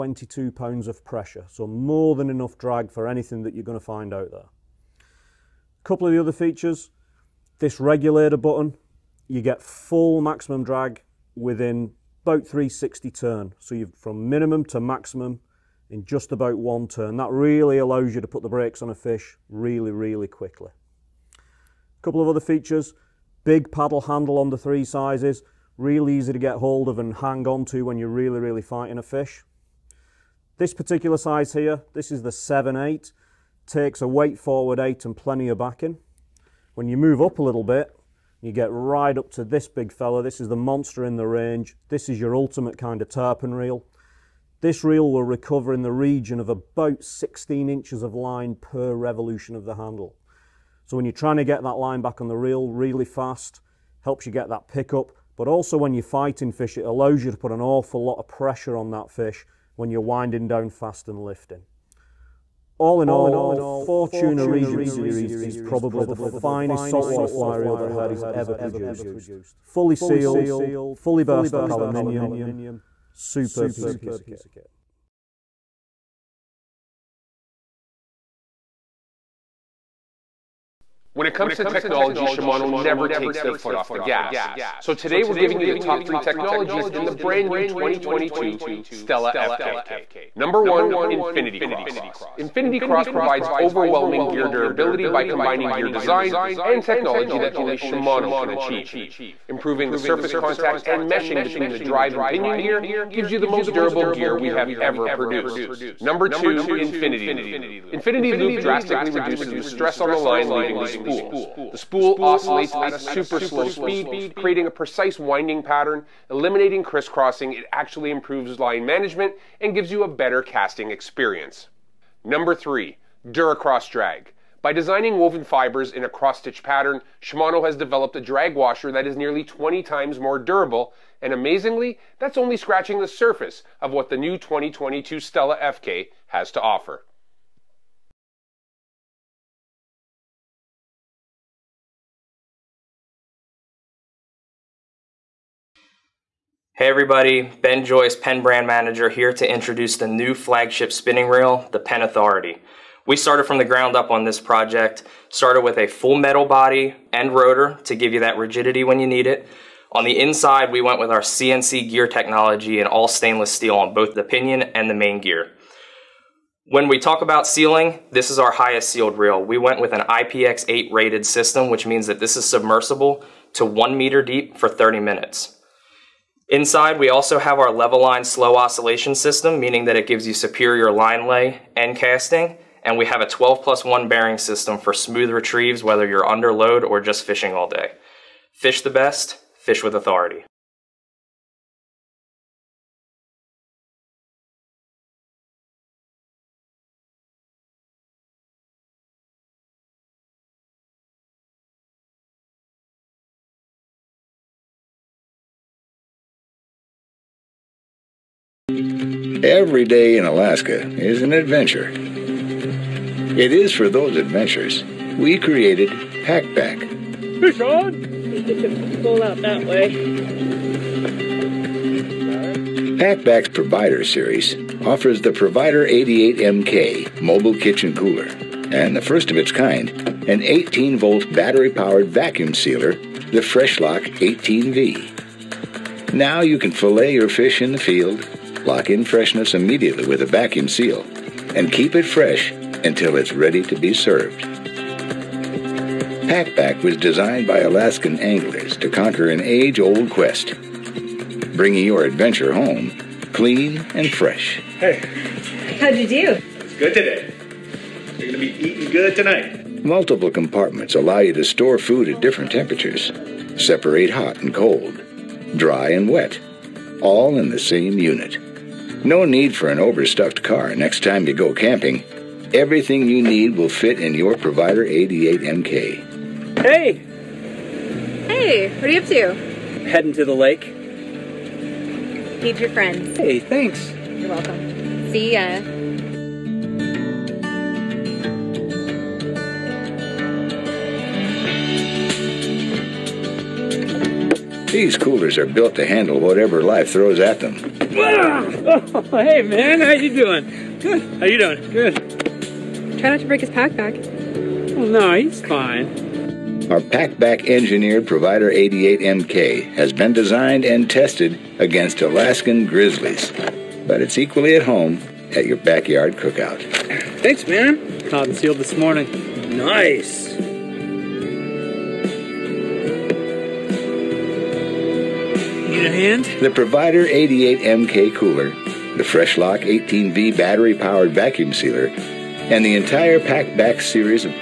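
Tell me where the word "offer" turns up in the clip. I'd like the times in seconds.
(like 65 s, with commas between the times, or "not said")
136 s, 224 s.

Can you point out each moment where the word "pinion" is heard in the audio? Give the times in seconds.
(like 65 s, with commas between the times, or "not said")
102 s, 164 s.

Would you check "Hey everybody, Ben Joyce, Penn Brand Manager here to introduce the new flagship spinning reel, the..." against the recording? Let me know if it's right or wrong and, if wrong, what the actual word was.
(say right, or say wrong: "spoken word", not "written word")
right.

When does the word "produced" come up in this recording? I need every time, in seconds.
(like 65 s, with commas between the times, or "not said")
68 s, 105 s.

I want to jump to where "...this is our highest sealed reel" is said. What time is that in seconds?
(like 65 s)
168 s.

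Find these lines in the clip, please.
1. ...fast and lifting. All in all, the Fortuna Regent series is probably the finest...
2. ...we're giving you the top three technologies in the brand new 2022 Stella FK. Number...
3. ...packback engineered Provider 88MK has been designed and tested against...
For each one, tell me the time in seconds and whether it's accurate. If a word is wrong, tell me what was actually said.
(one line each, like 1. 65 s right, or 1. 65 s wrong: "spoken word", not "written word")
1. 60 s right
2. 85 s right
3. 306 s right.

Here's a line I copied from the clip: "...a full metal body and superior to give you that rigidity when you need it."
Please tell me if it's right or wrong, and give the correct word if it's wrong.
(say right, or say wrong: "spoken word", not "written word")
wrong: "rotor", not "superior".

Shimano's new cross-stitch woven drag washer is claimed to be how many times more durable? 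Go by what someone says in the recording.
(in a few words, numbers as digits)
20 times.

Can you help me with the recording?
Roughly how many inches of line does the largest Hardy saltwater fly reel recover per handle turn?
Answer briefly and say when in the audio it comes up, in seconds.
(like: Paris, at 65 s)
16 inches, at 47 s.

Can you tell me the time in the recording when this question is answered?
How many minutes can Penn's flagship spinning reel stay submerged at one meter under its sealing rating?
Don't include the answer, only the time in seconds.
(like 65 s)
174 s.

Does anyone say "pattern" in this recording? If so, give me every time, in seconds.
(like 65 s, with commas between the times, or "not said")
115 s, 126 s.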